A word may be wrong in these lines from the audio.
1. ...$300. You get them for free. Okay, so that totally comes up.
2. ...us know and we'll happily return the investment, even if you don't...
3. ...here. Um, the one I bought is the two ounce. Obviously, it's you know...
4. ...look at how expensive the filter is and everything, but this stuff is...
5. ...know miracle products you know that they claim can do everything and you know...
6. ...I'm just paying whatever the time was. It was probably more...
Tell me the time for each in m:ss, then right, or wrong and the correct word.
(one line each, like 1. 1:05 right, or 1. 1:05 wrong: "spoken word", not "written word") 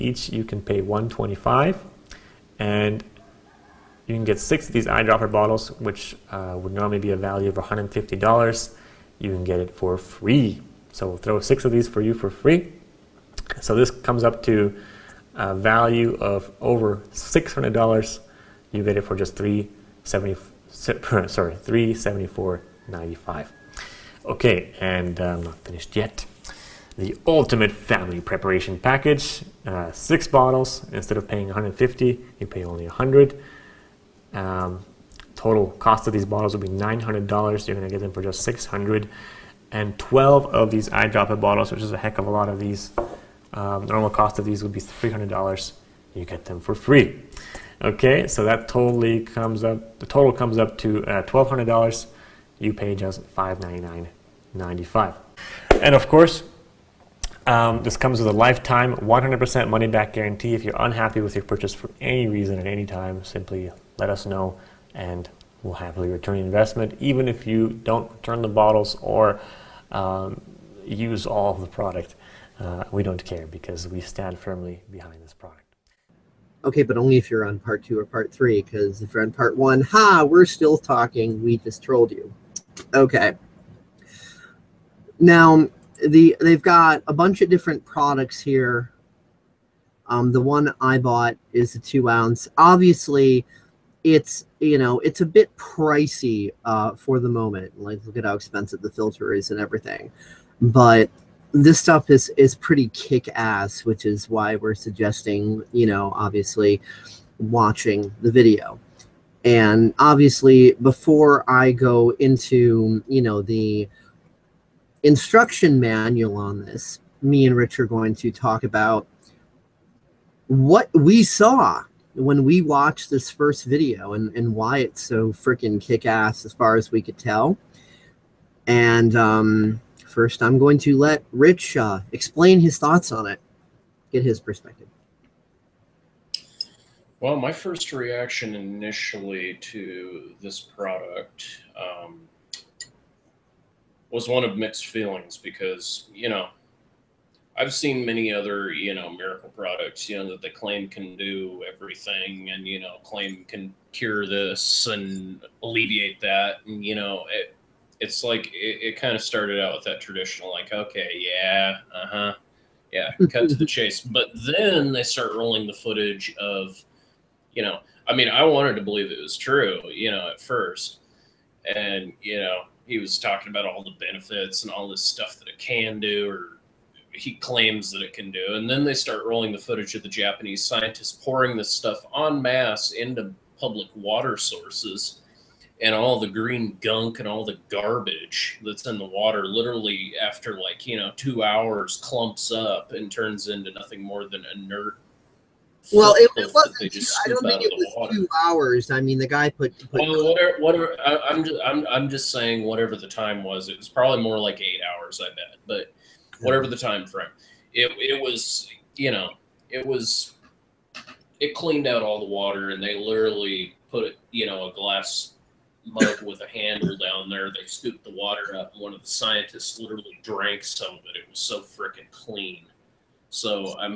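1. 0:44 right
2. 1:04 right
3. 1:28 right
4. 1:38 right
5. 2:28 right
6. 3:21 wrong: "saying", not "paying".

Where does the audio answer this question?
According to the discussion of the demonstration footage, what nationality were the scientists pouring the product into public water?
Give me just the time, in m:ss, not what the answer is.
3:00.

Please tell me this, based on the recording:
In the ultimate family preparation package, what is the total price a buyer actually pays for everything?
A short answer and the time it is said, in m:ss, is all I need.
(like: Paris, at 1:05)
$599.95, at 0:53.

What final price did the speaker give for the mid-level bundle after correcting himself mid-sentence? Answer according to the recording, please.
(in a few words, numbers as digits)
$374.95.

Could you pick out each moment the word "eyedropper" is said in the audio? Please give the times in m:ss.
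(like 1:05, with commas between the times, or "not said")
0:04, 0:40.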